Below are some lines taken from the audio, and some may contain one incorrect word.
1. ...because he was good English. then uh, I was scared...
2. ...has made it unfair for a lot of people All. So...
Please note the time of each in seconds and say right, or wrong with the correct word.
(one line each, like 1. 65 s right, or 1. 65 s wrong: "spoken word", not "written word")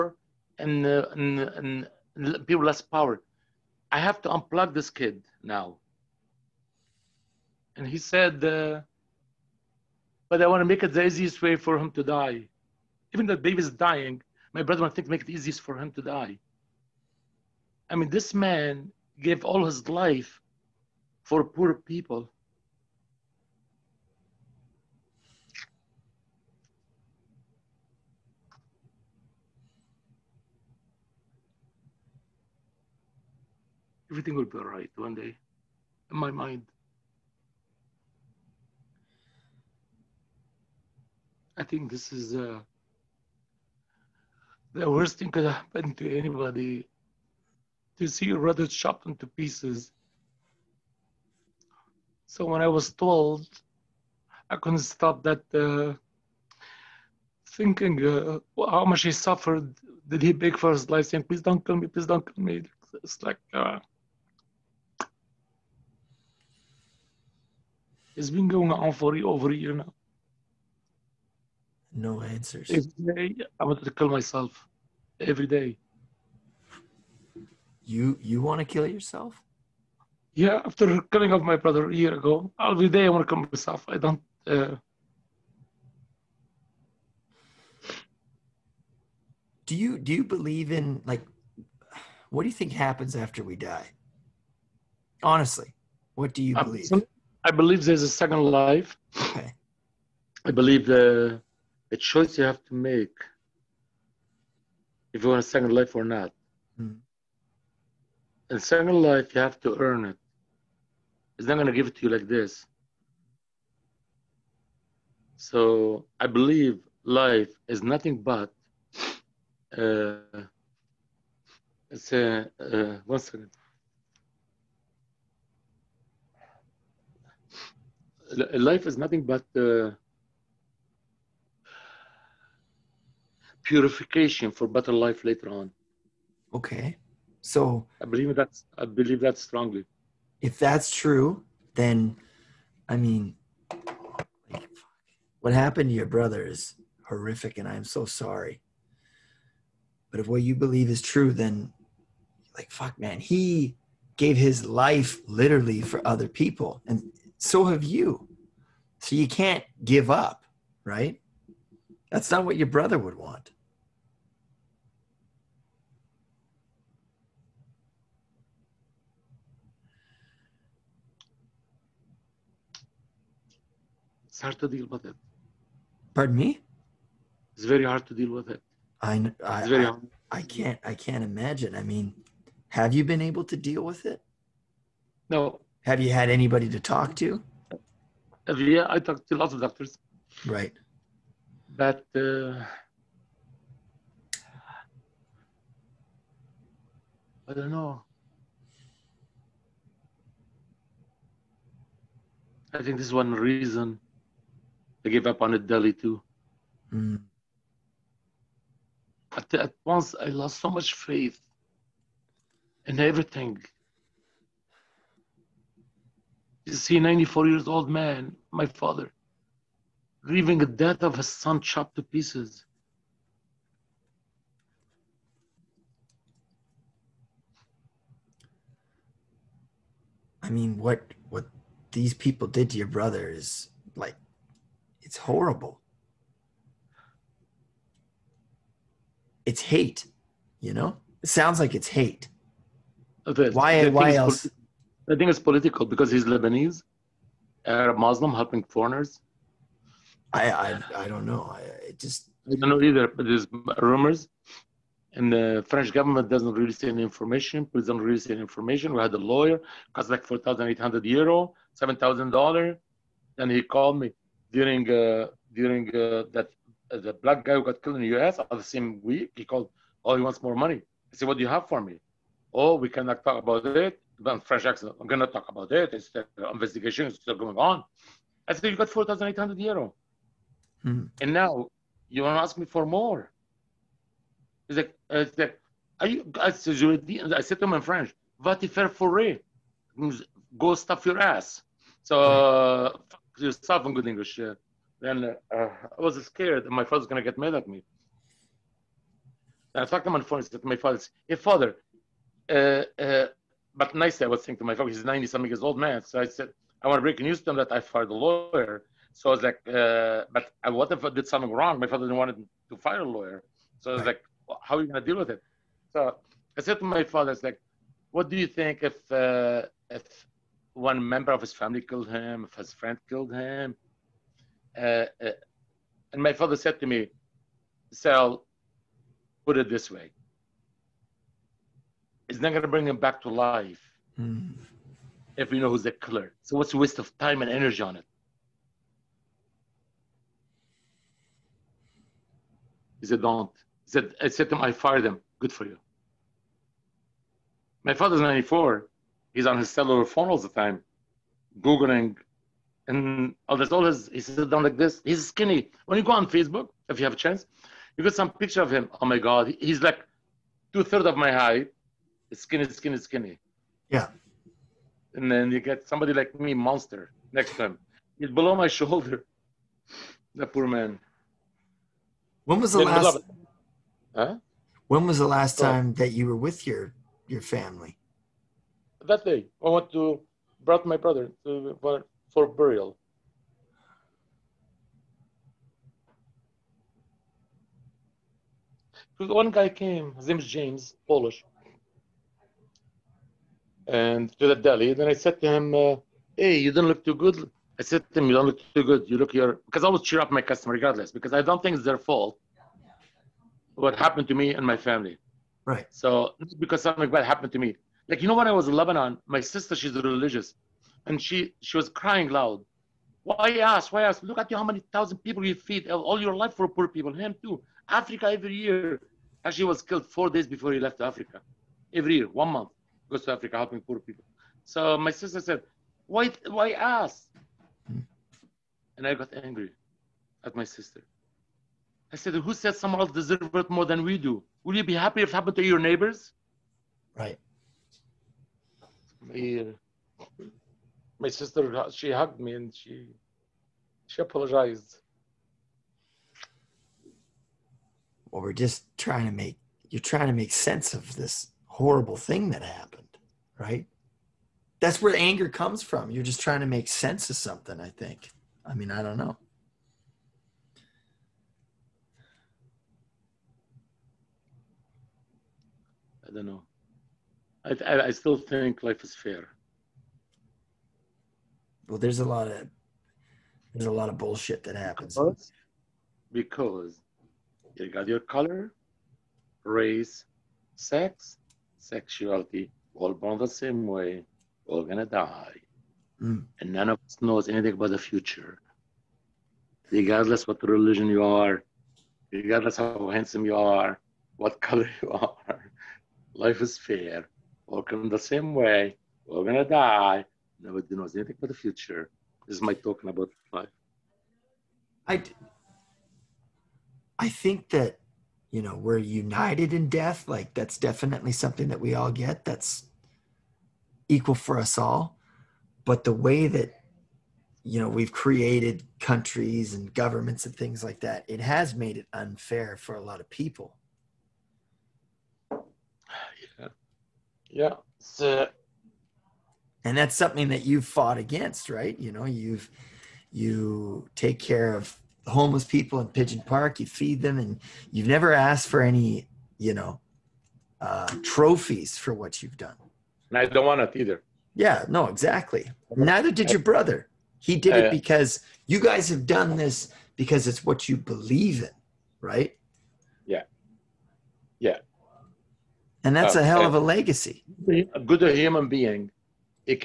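1. 293 s right
2. 521 s wrong: "Yeah", not "All".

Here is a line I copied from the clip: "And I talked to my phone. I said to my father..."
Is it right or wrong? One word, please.
right.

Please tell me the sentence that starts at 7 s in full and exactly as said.
And he said, uh, but I want to make it the easiest way for him to die.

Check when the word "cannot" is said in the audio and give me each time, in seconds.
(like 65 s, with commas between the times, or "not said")
272 s.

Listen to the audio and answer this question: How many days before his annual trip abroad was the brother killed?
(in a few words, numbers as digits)
Four days.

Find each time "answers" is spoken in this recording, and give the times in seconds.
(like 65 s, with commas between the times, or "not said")
72 s.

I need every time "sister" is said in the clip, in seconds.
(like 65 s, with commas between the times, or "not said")
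409 s, 425 s, 430 s, 441 s.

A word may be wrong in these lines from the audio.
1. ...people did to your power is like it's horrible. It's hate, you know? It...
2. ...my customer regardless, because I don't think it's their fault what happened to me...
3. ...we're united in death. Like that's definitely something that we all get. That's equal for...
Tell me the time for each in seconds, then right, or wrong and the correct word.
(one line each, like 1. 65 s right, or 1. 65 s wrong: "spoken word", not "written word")
1. 232 s wrong: "brother", not "power"
2. 400 s right
3. 508 s right.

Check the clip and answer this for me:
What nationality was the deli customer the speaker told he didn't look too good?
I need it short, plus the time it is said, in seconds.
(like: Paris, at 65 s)
Polish, at 391 s.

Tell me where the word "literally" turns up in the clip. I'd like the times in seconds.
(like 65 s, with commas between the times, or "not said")
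155 s.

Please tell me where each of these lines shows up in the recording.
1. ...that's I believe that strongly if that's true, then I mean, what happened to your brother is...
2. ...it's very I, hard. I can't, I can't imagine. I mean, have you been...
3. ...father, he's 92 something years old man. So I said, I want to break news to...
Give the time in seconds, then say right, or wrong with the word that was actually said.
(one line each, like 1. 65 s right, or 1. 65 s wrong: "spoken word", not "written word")
1. 138 s right
2. 179 s right
3. 304 s wrong: "90", not "92".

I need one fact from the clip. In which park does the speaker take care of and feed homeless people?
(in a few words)
Pigeon Park.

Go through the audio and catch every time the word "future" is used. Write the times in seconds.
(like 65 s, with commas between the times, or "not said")
487 s, 501 s.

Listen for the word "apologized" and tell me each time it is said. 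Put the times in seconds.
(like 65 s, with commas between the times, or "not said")
444 s.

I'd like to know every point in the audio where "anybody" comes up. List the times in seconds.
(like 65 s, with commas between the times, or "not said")
46 s, 186 s.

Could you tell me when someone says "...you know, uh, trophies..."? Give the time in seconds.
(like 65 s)
539 s.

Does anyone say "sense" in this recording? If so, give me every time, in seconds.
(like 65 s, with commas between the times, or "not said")
450 s, 456 s.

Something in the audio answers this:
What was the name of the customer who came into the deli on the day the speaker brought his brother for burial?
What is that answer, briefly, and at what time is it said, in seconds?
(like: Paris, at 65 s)
James, at 390 s.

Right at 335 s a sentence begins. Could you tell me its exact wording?
if we know who's the killer.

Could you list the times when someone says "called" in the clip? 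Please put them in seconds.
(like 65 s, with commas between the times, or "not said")
263 s, 269 s.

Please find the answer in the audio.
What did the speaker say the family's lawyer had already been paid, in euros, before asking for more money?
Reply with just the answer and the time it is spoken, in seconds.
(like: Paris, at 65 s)
4,800 euros, at 278 s.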